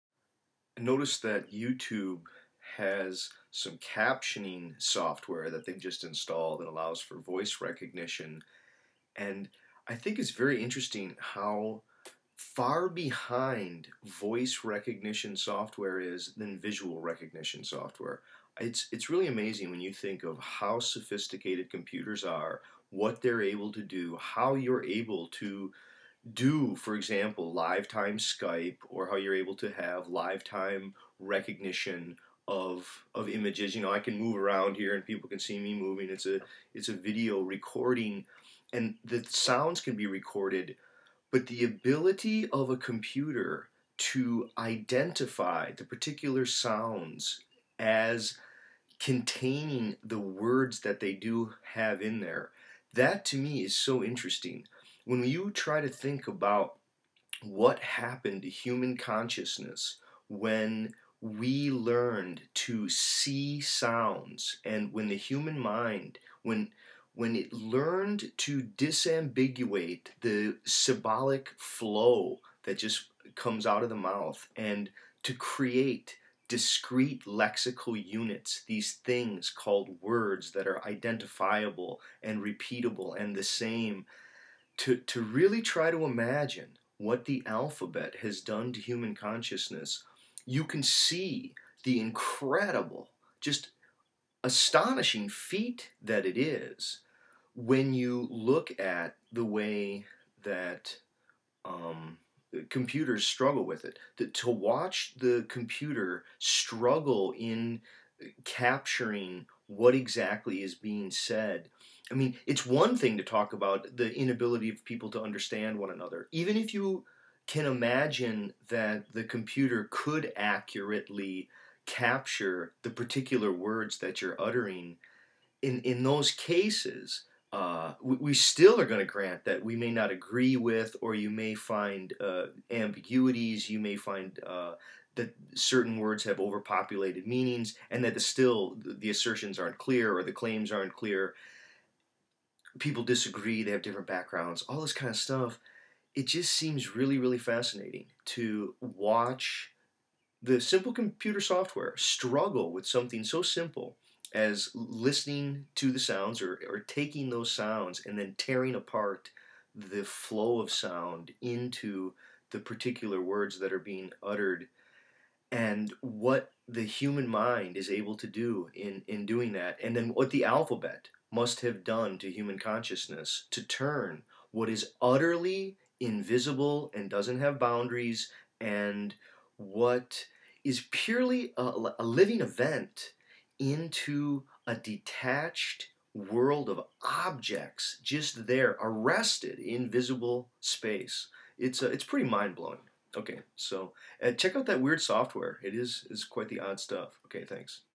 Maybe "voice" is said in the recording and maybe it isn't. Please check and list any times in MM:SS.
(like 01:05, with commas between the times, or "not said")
00:07, 00:14.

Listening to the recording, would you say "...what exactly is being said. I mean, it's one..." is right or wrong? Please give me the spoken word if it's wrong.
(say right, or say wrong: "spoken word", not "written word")
right.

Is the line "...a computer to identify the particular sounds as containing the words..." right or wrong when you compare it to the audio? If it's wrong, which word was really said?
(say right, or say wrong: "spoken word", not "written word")
right.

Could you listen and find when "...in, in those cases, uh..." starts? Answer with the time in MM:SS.
02:05.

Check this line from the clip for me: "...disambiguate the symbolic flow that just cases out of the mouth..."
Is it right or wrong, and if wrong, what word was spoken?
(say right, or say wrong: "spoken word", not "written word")
wrong: "comes", not "cases".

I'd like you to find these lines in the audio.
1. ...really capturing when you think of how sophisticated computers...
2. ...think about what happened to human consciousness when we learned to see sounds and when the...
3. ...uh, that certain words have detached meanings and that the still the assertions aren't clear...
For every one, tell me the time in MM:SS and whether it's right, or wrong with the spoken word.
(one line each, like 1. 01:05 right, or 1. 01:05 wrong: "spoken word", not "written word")
1. 00:19 wrong: "amazing", not "capturing"
2. 00:55 right
3. 02:14 wrong: "overpopulated", not "detached".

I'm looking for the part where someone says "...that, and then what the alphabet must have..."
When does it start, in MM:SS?
02:49.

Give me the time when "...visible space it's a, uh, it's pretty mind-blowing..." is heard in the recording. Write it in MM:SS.
03:09.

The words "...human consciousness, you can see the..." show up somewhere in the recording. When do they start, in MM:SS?
01:28.